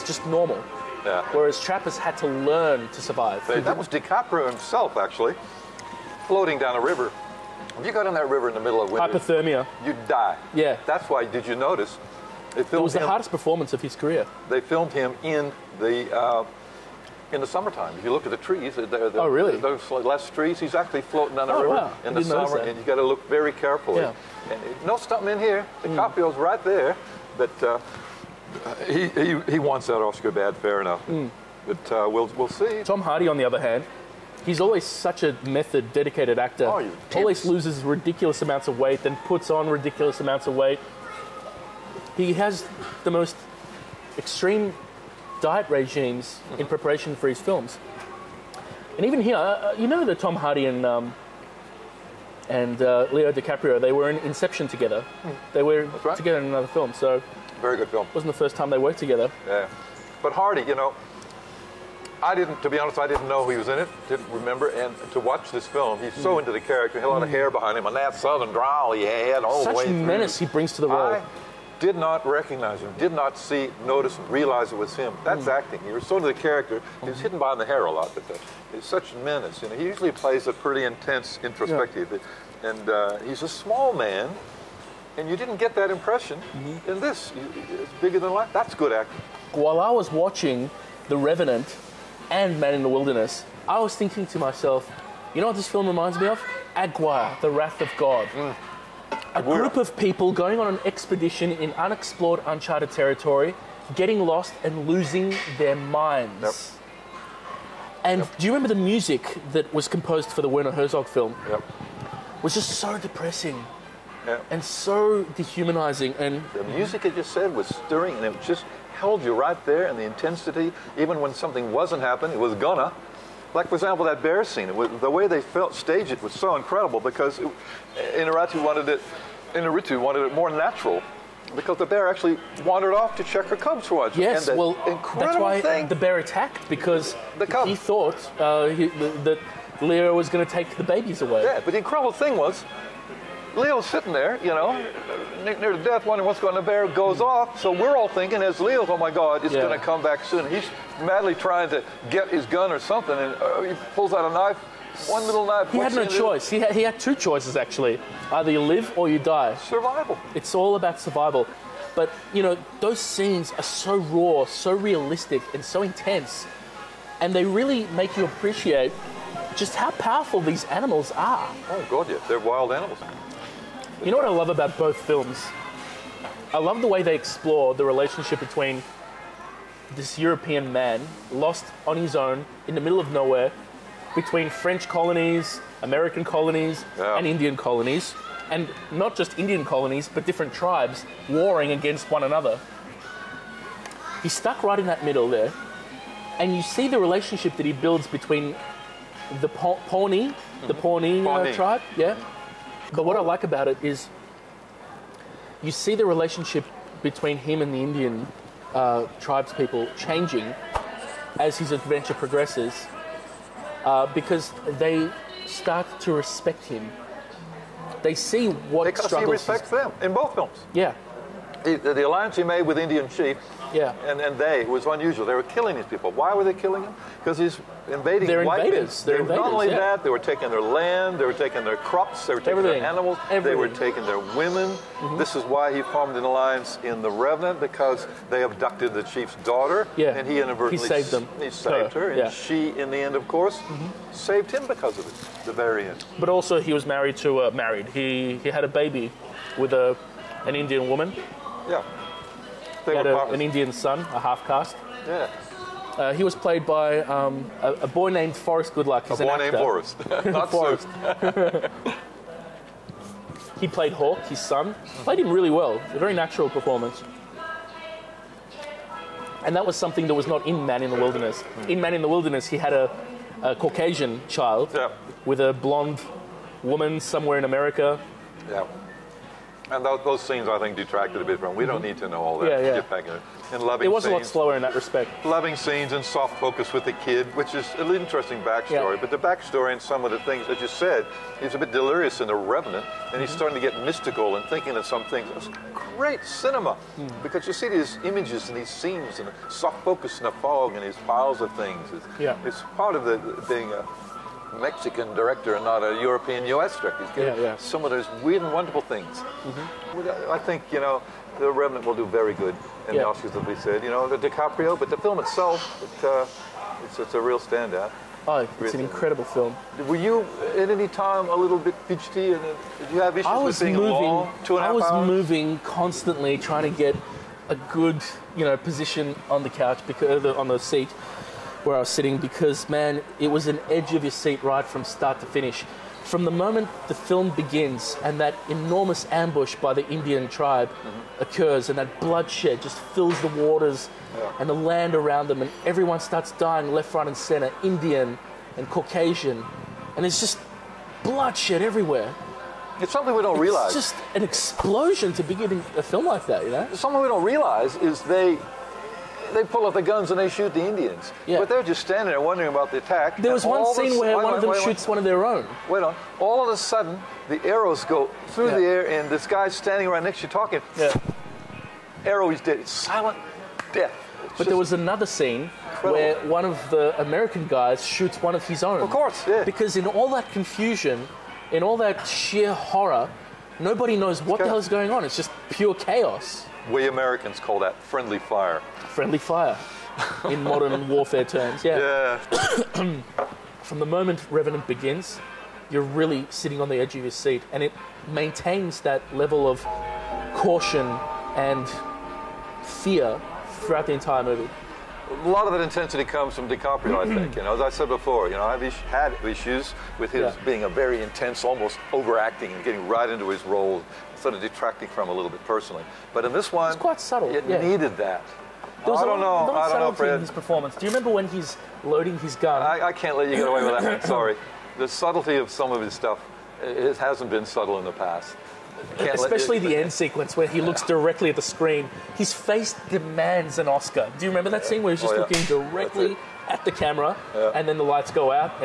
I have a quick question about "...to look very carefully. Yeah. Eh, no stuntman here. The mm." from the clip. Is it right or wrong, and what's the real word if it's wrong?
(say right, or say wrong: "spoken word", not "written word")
right.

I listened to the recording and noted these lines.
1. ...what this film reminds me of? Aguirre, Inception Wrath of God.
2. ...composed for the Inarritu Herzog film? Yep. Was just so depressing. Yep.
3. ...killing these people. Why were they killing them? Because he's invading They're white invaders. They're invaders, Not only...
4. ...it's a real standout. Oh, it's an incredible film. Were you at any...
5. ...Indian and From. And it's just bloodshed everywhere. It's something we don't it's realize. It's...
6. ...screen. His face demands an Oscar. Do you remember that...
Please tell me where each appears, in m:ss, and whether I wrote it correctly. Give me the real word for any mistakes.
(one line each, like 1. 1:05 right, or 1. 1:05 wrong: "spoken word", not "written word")
1. 1:35 wrong: "The", not "Inception"
2. 1:49 wrong: "Werner", not "Inarritu"
3. 3:45 right
4. 5:17 right
5. 5:47 wrong: "Caucasian", not "From"
6. 7:11 right.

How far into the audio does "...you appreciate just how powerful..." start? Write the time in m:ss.
2:48.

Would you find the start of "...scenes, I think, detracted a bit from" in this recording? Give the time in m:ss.
4:40.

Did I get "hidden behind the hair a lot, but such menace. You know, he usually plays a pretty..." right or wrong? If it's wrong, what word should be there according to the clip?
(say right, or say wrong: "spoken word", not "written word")
right.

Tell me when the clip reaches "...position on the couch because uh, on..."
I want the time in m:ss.
5:28.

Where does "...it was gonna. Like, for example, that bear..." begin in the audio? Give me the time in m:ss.
2:02.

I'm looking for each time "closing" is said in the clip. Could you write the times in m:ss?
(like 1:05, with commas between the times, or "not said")
not said.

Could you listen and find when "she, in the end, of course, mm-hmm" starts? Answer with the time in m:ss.
4:02.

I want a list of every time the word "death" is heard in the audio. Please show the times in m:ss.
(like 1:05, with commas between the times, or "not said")
2:25, 6:13.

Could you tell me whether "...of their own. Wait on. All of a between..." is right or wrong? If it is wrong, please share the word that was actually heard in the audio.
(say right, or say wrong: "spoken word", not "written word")
wrong: "sudden", not "between".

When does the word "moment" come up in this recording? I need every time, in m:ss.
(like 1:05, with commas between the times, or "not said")
5:36, 6:33.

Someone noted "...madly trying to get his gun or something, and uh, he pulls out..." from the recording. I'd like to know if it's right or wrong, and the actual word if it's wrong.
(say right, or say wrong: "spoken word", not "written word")
right.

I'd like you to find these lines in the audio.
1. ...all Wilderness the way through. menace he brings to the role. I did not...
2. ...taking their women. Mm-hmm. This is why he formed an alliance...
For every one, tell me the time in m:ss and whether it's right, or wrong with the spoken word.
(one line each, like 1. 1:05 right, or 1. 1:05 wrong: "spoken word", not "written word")
1. 1:09 wrong: "Such", not "Wilderness"
2. 3:53 right.